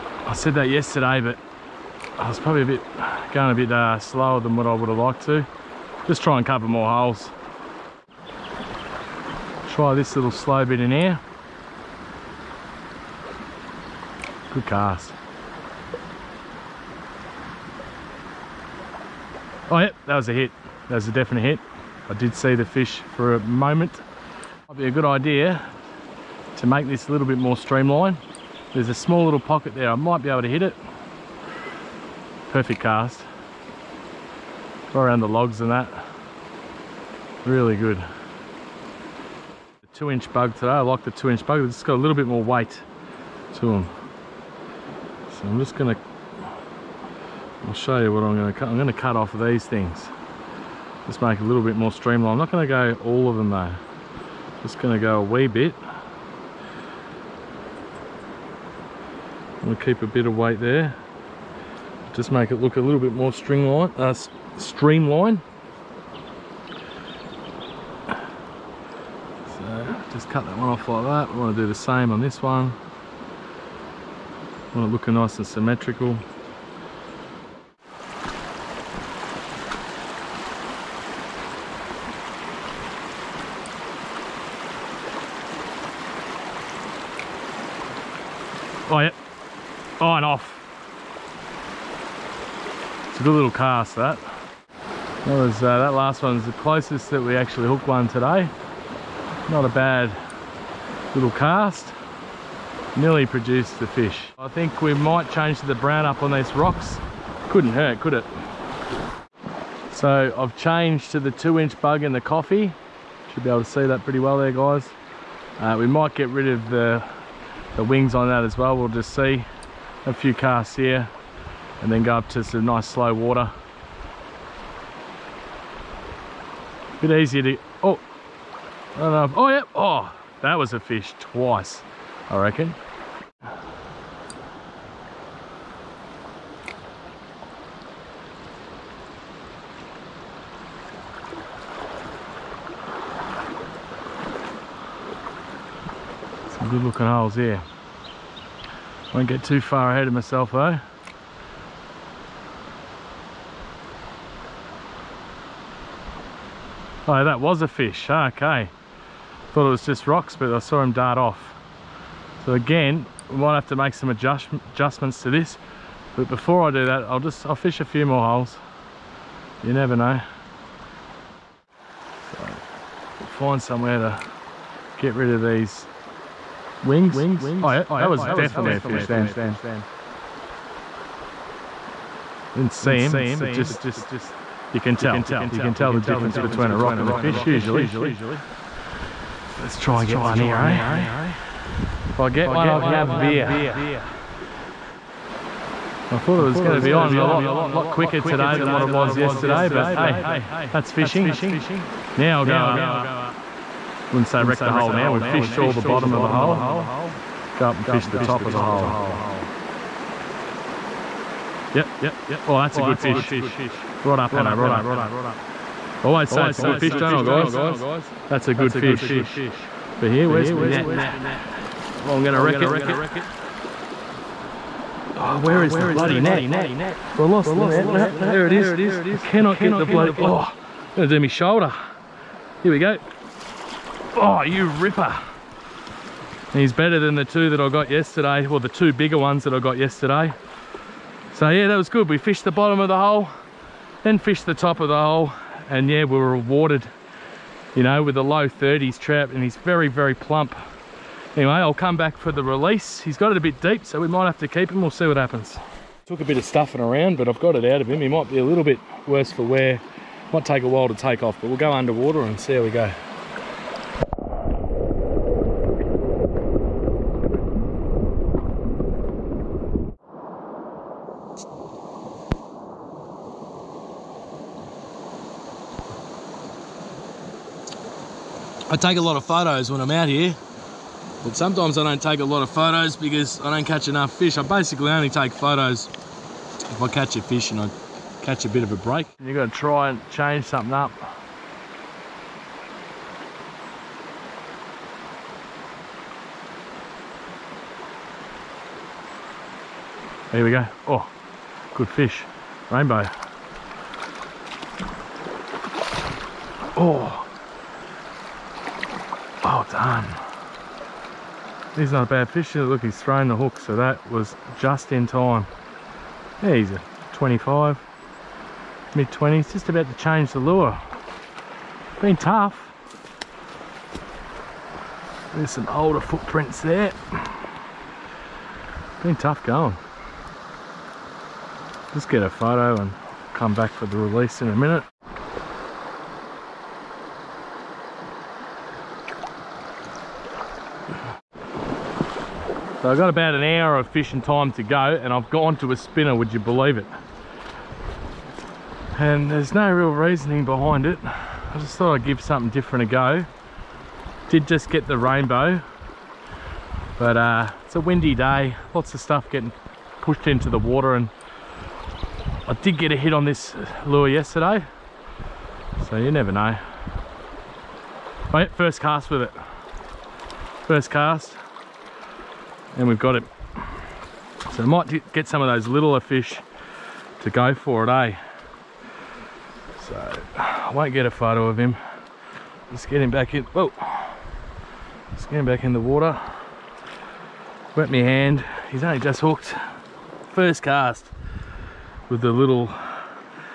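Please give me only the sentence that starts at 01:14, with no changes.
want it looking nice and symmetrical.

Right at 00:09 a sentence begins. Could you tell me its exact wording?
Try this little slow bit in here.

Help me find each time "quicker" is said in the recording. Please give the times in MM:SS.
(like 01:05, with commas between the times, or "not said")
03:17.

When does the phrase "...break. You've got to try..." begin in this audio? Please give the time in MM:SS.
04:48.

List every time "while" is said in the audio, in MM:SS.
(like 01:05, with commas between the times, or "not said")
04:20.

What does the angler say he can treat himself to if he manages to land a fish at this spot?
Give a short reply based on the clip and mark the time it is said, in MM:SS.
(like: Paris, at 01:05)
A beer, at 03:13.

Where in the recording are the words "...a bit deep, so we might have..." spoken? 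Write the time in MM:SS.
04:13.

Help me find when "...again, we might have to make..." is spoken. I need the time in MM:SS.
02:42.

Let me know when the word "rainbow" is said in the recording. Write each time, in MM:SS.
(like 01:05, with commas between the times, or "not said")
05:02, 05:54.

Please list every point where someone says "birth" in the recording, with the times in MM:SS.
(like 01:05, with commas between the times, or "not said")
not said.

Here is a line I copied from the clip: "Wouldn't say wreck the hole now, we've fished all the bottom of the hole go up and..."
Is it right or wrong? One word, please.
right.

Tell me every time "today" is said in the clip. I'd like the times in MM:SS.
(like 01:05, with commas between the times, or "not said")
00:40, 01:38, 03:18.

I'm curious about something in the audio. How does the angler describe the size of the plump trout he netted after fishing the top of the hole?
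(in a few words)
Low 30s.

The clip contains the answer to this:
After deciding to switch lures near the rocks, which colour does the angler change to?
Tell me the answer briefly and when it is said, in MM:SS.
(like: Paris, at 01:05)
Brown, at 01:45.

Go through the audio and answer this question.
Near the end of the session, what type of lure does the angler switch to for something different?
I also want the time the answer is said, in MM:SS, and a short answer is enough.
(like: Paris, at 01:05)
A spinner, at 05:45.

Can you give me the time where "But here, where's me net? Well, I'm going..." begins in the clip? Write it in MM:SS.
03:40.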